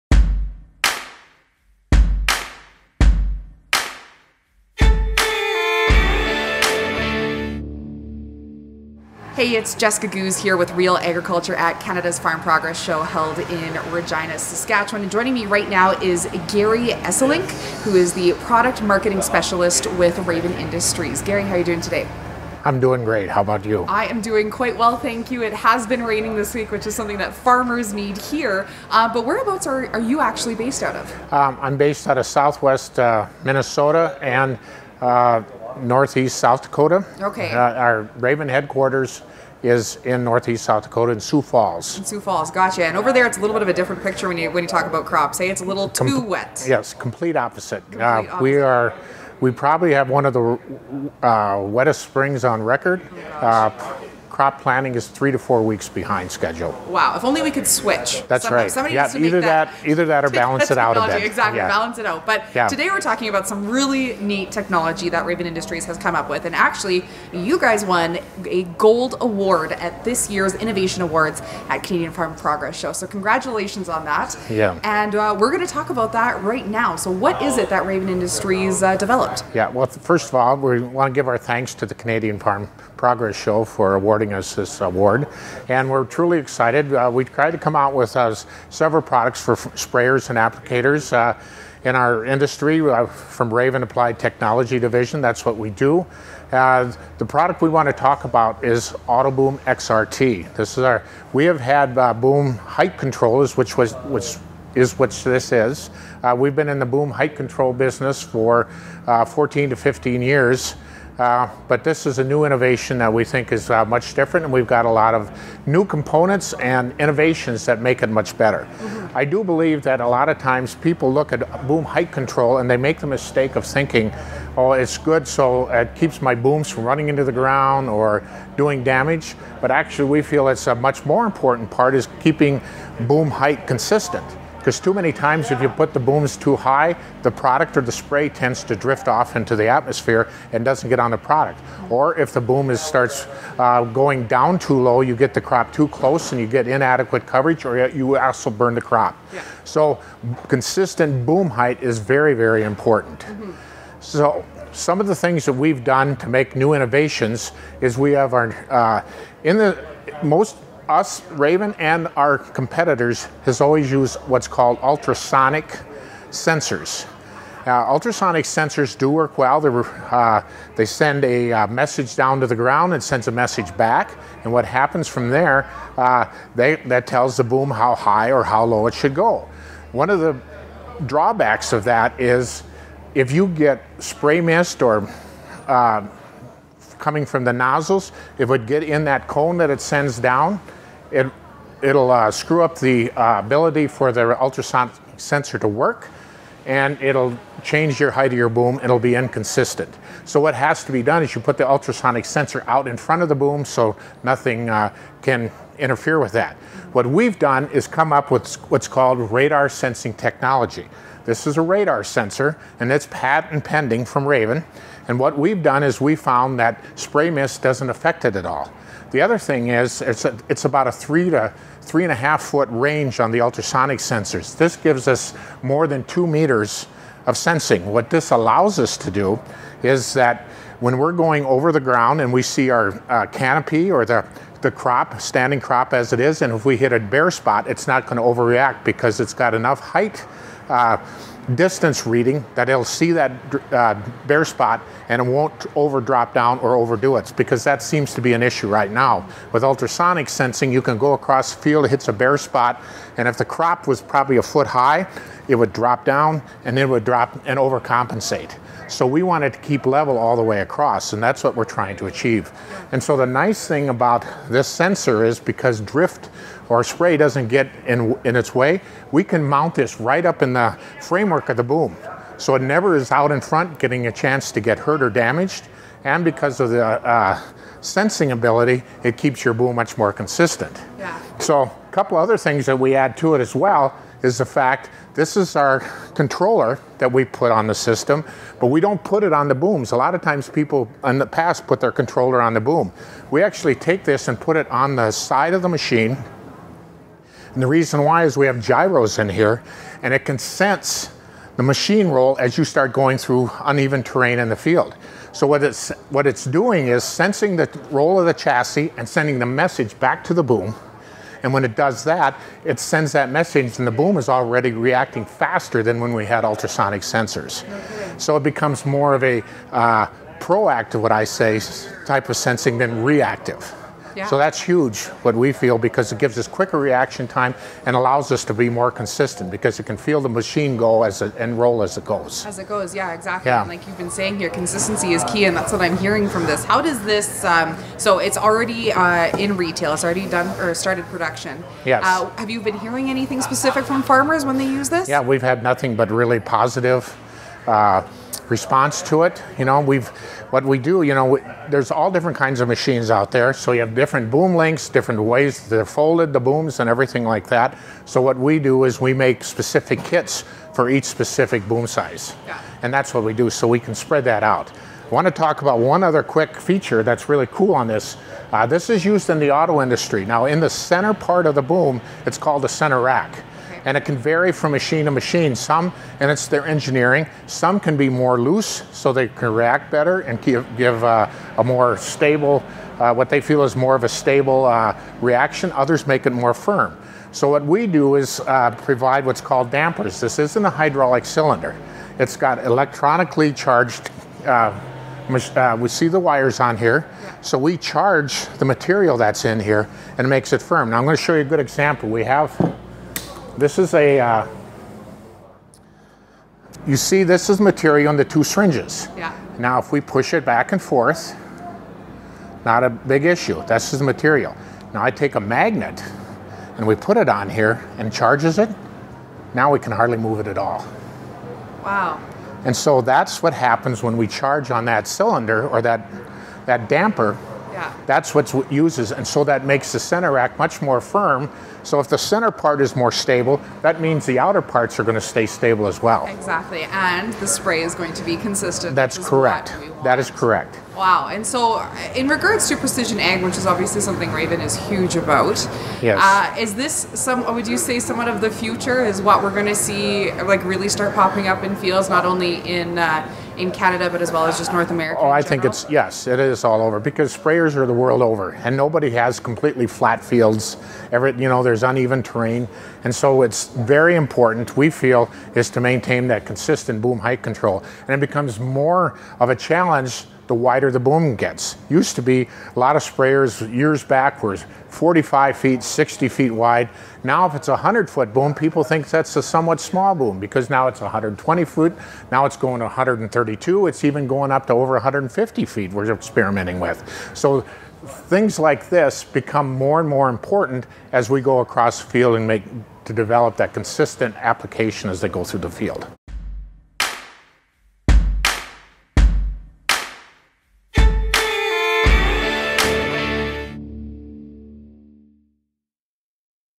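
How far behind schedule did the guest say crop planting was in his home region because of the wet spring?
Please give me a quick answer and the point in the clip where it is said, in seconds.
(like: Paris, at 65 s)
3 to 4 weeks, at 55 s.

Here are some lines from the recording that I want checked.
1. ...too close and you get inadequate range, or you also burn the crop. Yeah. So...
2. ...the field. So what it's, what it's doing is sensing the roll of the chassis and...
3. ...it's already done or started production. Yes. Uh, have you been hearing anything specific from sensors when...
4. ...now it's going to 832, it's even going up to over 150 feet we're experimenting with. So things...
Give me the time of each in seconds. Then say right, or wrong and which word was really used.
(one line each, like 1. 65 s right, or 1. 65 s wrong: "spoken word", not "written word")
1. 145 s wrong: "coverage", not "range"
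2. 304 s right
3. 339 s wrong: "farmers", not "sensors"
4. 482 s wrong: "132", not "832".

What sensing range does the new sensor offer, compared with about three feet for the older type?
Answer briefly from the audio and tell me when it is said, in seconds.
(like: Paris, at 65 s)
more than 2 meters, at 225 s.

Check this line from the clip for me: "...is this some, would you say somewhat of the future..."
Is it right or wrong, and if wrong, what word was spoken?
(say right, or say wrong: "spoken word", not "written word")
right.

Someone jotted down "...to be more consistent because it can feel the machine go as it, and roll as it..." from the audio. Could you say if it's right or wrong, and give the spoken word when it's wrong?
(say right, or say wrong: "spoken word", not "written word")
right.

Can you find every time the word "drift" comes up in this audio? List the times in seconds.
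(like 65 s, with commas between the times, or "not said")
138 s, 265 s.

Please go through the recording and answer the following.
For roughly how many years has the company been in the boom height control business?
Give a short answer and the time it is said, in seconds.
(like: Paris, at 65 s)
14 to 15 years, at 109 s.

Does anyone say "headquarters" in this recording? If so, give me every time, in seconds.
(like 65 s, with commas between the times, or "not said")
38 s.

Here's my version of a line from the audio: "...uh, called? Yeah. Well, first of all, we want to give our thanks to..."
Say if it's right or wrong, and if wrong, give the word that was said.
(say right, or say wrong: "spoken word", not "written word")
wrong: "developed", not "called".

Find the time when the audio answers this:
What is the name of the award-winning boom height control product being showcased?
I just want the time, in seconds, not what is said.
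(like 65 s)
99 s.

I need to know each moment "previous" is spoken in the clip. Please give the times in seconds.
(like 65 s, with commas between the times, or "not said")
not said.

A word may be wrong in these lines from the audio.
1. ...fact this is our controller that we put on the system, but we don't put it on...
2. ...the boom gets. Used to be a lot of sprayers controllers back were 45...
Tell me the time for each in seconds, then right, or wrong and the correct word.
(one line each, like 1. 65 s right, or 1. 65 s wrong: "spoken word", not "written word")
1. 284 s right
2. 470 s wrong: "years", not "controllers".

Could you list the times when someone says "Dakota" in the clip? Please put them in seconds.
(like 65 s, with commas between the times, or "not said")
36 s, 40 s.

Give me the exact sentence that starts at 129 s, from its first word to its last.
But actually, we feel it's a much more important part is keeping boom height consistent.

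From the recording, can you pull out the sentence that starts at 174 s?
And what happens from there, uh, they, that tells the boom how high or how low it should go.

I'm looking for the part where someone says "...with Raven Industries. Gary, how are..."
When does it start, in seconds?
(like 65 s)
19 s.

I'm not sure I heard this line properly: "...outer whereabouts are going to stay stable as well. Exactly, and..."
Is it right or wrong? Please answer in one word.
wrong.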